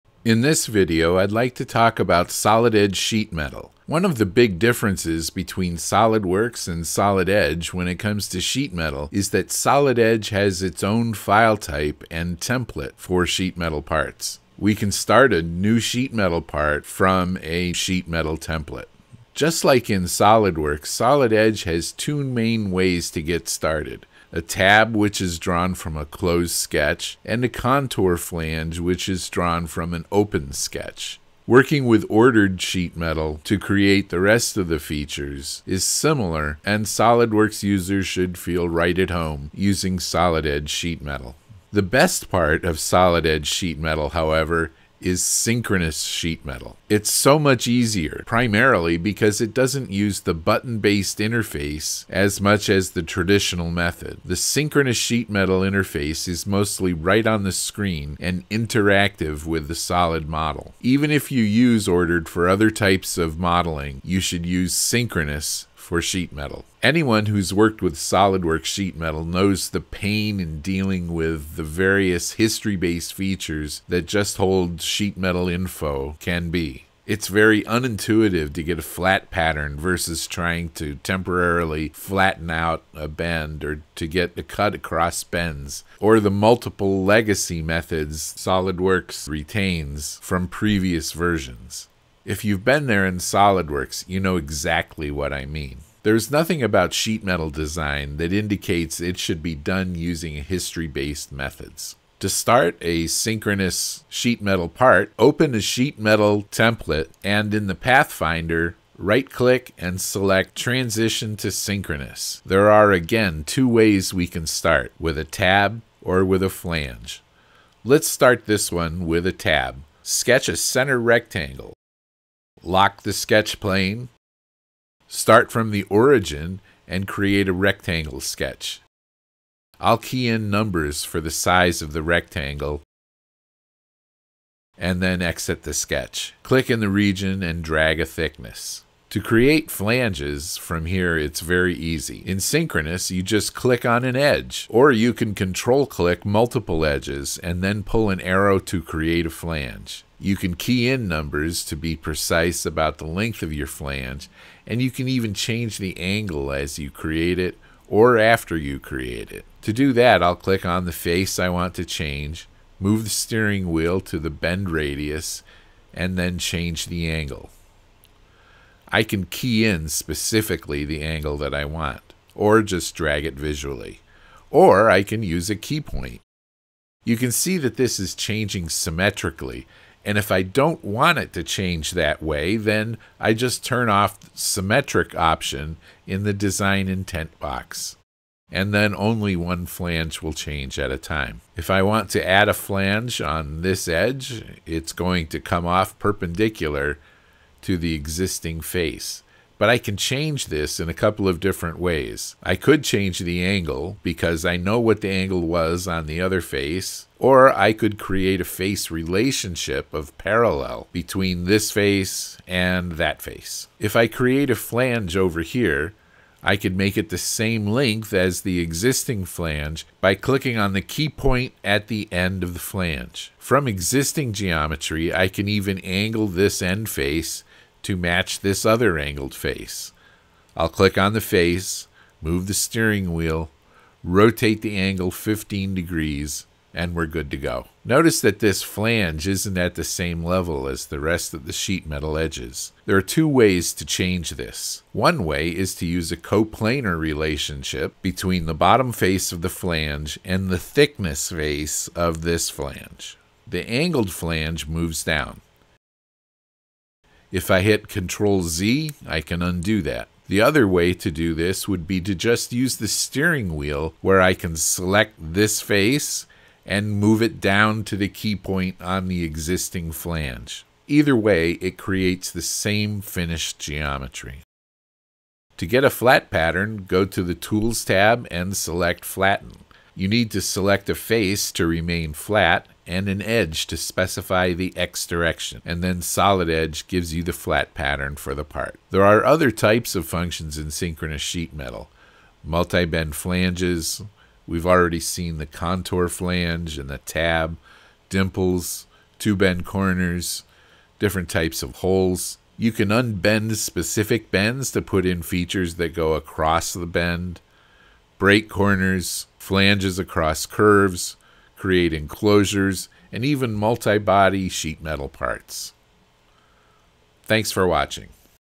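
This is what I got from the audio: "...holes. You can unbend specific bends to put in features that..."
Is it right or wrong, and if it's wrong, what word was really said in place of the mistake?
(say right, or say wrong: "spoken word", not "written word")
right.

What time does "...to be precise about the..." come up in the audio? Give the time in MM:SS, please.
02:31.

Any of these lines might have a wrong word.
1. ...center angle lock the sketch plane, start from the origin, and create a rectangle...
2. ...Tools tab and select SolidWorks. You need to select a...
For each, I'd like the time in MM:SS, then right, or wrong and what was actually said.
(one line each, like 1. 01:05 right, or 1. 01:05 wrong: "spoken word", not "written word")
1. 02:00 wrong: "rectangle", not "angle"
2. 04:37 wrong: "Flatten", not "SolidWorks".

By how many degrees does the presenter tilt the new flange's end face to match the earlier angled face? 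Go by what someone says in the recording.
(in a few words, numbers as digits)
15 degrees.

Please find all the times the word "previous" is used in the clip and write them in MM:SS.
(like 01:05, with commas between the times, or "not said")
01:30.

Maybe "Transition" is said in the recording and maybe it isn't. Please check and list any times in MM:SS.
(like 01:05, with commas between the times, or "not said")
01:50.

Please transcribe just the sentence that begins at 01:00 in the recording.
Even if you use ordered for other types of modeling, you should use synchronous for sheet metal.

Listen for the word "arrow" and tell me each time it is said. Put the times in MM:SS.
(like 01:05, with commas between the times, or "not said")
02:28.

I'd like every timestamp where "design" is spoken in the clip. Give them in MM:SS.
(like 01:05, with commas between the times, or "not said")
01:37, 03:06.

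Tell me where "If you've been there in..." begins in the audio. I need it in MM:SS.
01:32.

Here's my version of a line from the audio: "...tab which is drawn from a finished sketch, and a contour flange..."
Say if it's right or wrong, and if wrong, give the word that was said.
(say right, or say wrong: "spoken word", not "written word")
wrong: "closed", not "finished".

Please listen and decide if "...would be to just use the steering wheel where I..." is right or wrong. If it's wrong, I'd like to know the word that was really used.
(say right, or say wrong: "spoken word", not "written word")
right.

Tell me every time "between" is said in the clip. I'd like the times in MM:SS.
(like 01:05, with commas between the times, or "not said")
00:05, 03:30, 04:08.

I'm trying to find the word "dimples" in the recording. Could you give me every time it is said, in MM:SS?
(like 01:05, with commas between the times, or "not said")
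04:58.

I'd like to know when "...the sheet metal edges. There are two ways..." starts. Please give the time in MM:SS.
04:01.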